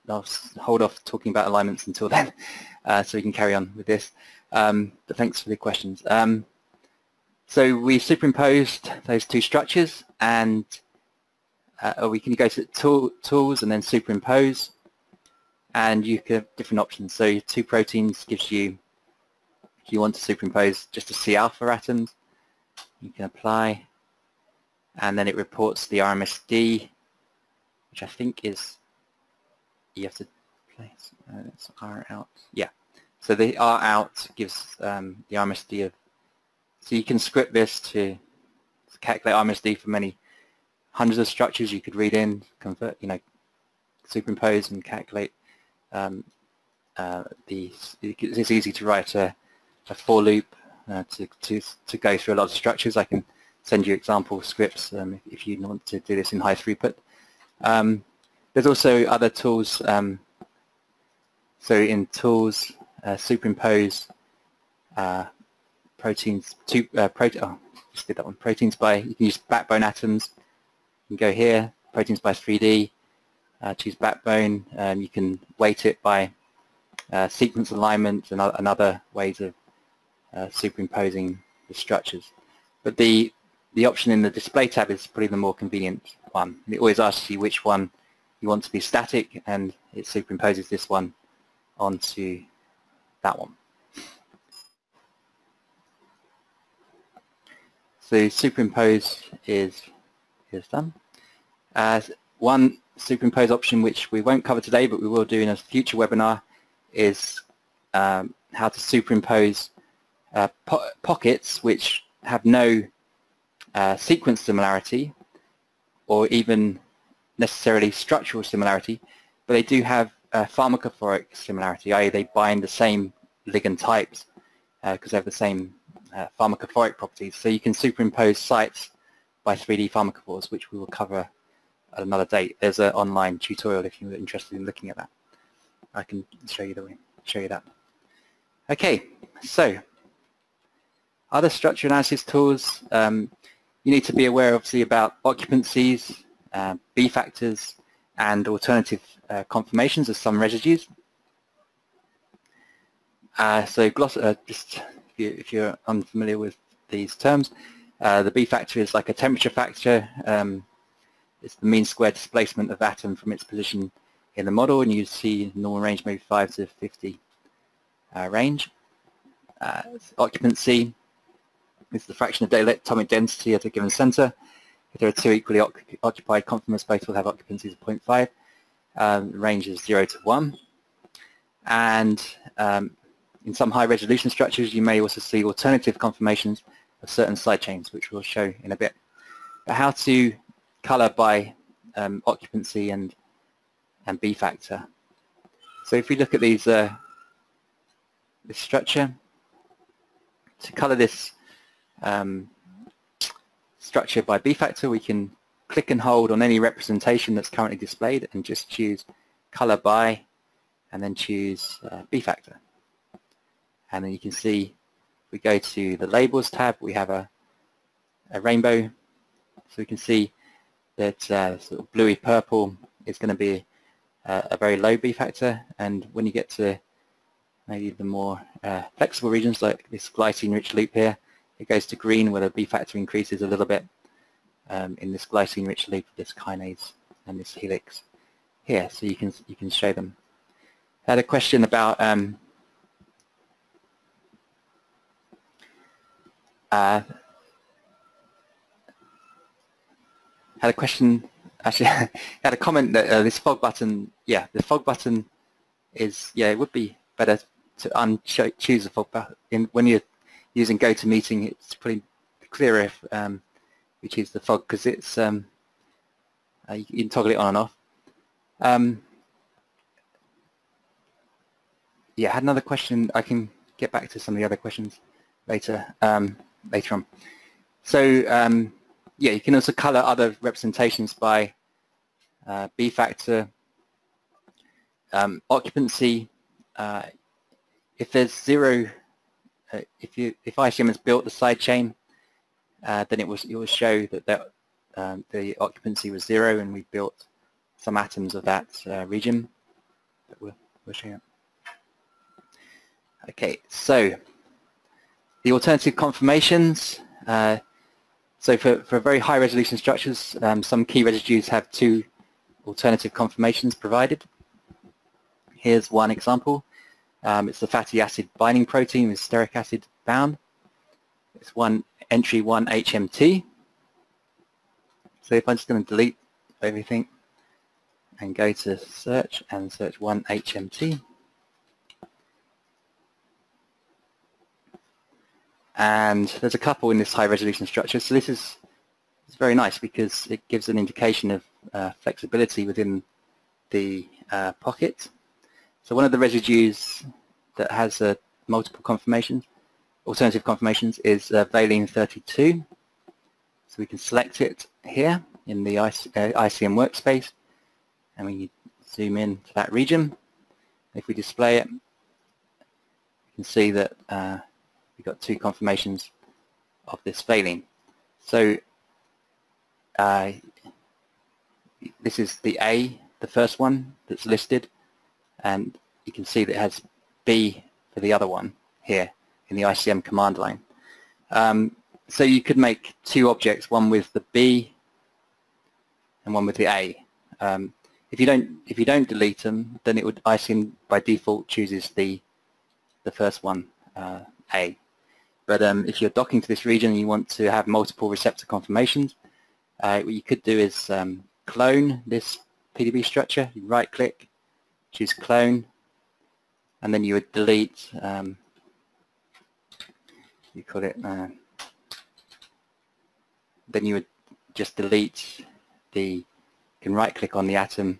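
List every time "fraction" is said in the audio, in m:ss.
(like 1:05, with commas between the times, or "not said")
2:52.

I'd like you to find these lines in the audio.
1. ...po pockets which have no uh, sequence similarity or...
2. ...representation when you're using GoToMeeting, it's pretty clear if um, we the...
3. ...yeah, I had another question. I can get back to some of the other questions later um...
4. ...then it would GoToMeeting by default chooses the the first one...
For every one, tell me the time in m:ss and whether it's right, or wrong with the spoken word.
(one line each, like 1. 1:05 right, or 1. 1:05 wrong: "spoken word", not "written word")
1. 1:50 right
2. 4:19 wrong: "button", not "representation"
3. 4:32 right
4. 6:29 wrong: "ICM", not "GoToMeeting".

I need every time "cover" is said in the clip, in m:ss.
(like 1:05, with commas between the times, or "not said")
1:44, 2:10.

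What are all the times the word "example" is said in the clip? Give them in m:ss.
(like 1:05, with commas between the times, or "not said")
0:53, 5:16.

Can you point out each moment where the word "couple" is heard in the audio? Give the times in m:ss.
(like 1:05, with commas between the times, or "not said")
5:36.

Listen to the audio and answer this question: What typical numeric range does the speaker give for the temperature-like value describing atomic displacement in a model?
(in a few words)
5 to 50.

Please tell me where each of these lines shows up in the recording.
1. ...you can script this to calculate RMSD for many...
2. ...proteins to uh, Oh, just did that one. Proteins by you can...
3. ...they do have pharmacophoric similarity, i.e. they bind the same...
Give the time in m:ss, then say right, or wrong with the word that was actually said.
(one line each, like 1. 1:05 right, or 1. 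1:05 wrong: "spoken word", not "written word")
1. 0:36 right
2. 1:05 right
3. 1:59 right.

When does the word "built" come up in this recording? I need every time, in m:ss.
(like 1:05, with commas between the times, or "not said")
4:50, 4:56.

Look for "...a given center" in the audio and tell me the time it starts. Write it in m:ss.
2:53.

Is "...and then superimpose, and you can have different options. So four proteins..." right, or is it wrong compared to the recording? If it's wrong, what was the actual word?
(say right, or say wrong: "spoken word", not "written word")
wrong: "two", not "four".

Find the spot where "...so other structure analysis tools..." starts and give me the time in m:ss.
2:19.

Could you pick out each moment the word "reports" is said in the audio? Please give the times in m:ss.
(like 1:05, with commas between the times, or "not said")
0:25.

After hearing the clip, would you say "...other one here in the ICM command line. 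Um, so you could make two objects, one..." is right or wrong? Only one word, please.
right.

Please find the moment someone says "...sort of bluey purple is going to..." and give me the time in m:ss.
3:41.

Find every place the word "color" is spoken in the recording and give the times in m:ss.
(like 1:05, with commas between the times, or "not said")
3:10, 3:20, 3:29, 4:39.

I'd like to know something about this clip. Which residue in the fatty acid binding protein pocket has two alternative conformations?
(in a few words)
valine 32.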